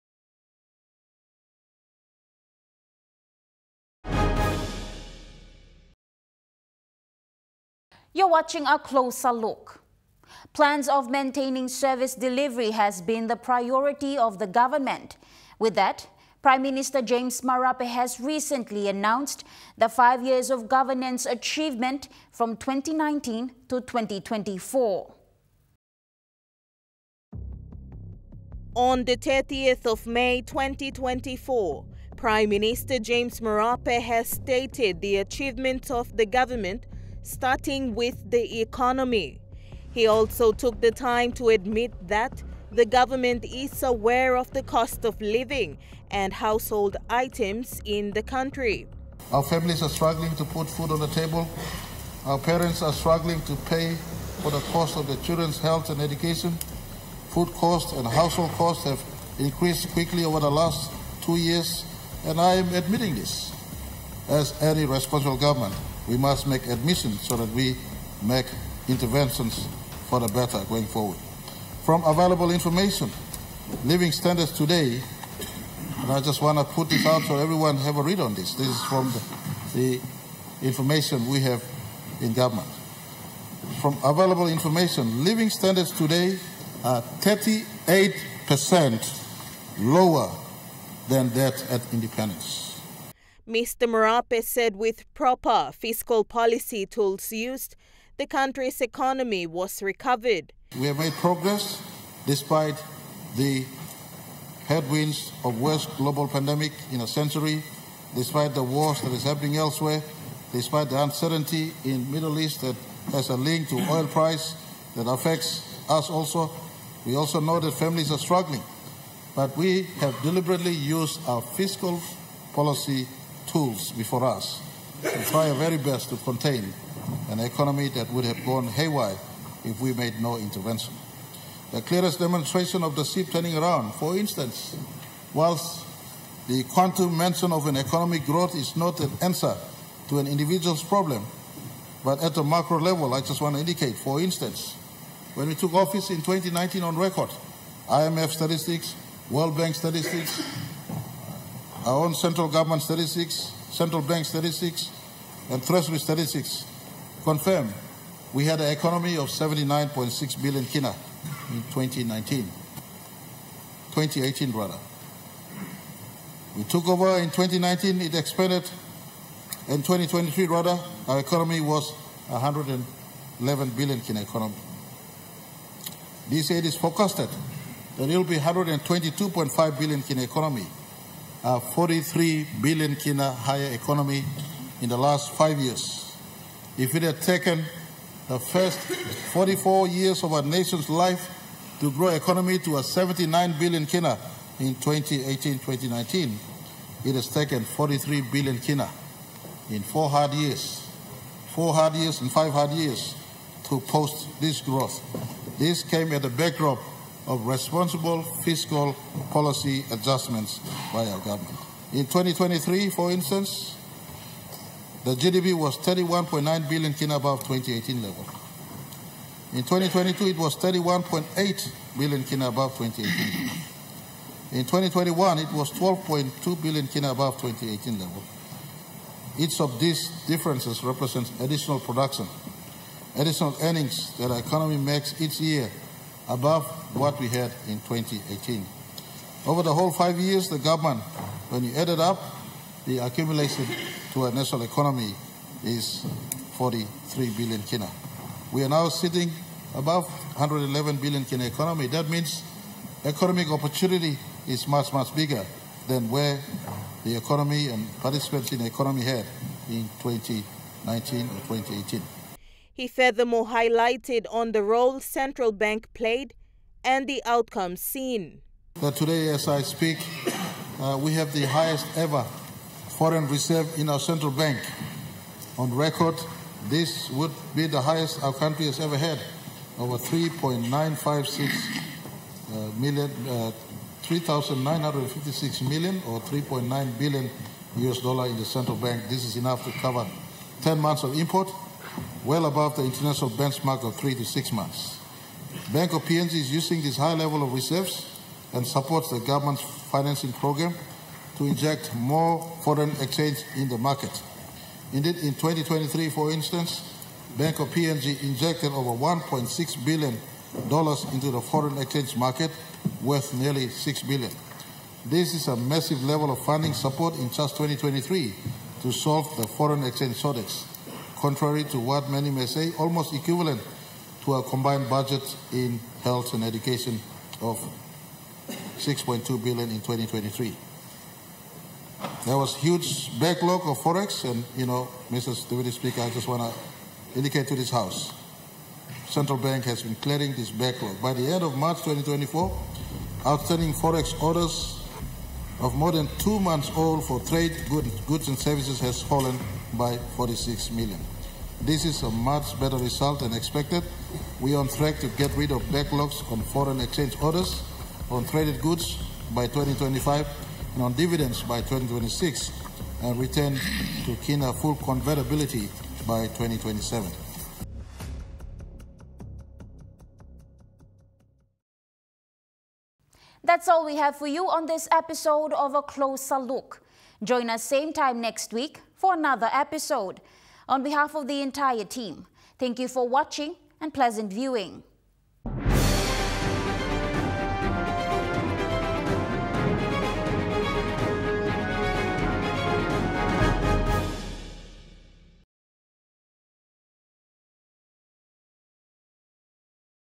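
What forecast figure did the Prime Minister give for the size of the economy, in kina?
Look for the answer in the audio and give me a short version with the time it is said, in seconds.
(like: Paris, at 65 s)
122.5 billion kina, at 178 s.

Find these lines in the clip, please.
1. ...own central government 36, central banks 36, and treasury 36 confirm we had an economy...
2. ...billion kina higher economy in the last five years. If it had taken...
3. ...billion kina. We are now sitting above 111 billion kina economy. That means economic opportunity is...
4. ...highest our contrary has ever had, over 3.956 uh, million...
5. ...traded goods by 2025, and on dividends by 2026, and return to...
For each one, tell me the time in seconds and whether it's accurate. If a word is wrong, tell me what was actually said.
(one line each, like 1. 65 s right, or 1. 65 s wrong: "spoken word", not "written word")
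1. 152 s right
2. 182 s right
3. 247 s right
4. 277 s wrong: "country", not "contrary"
5. 358 s right.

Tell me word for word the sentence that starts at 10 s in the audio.
Plans of maintaining service delivery has been the priority of the government.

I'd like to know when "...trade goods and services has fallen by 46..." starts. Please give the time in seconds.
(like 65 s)
347 s.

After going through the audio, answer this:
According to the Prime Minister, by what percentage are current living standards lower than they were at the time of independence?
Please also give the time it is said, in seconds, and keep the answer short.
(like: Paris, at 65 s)
38%, at 87 s.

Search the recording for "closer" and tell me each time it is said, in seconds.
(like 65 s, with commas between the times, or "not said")
8 s, 375 s.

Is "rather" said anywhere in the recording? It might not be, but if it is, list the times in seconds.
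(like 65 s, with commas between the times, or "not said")
164 s, 170 s.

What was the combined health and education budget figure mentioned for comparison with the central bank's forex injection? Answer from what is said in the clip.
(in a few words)
6.2 billion.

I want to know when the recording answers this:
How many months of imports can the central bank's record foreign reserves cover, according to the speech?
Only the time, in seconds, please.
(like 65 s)
290 s.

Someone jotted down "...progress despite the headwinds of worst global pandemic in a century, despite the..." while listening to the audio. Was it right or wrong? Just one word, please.
right.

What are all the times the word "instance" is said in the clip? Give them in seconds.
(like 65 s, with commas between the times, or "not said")
134 s, 144 s, 213 s, 306 s.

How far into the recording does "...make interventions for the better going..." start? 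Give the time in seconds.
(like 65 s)
68 s.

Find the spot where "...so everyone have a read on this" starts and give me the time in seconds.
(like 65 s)
77 s.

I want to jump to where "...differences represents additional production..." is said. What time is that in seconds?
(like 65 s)
230 s.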